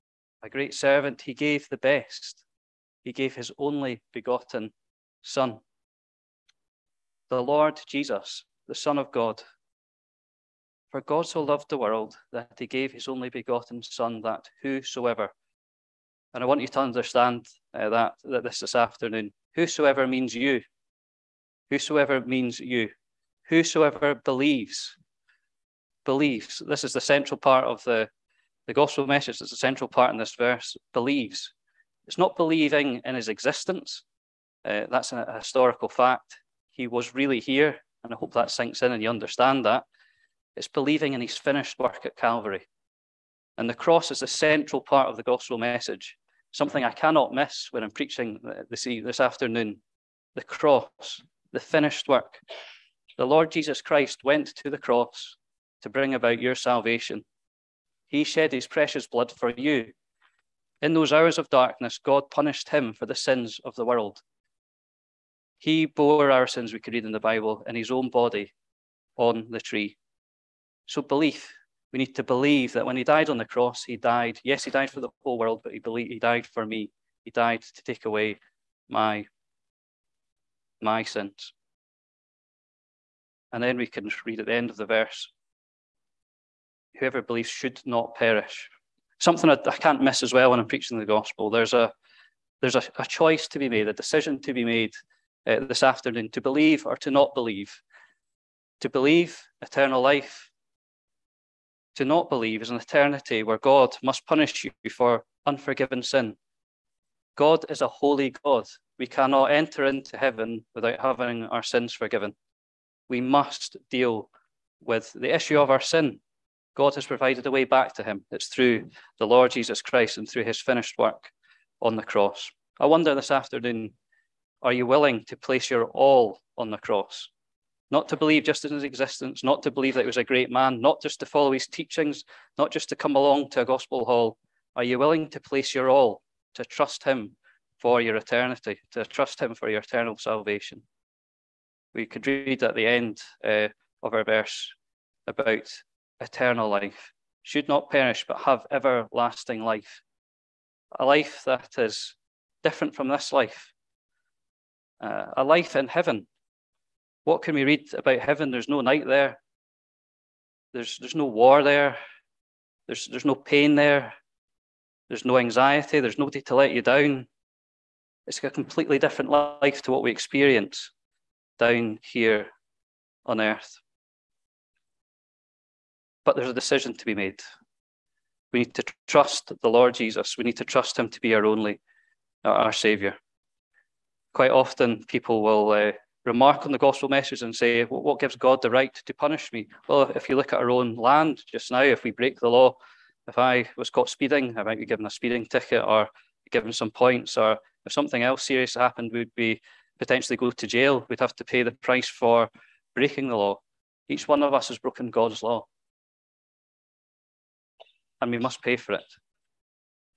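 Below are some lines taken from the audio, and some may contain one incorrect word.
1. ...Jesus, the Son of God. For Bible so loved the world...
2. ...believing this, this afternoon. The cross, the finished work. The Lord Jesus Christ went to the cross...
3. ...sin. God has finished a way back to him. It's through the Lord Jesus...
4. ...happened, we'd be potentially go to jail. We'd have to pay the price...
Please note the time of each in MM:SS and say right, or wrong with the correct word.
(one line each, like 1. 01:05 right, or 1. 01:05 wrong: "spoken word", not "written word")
1. 00:07 wrong: "God", not "Bible"
2. 00:47 wrong: "preaching", not "believing"
3. 01:55 wrong: "provided", not "finished"
4. 03:18 right.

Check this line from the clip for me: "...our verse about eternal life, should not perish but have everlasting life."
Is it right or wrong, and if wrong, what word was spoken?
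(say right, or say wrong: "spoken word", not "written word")
right.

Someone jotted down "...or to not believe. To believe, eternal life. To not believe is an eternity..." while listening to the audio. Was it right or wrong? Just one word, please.
right.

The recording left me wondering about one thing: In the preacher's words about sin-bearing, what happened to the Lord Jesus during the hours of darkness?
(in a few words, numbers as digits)
God punished him.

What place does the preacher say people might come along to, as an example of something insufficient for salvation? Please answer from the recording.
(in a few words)
a gospel hall.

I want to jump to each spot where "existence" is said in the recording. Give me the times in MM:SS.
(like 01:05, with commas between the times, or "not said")
00:33, 02:08.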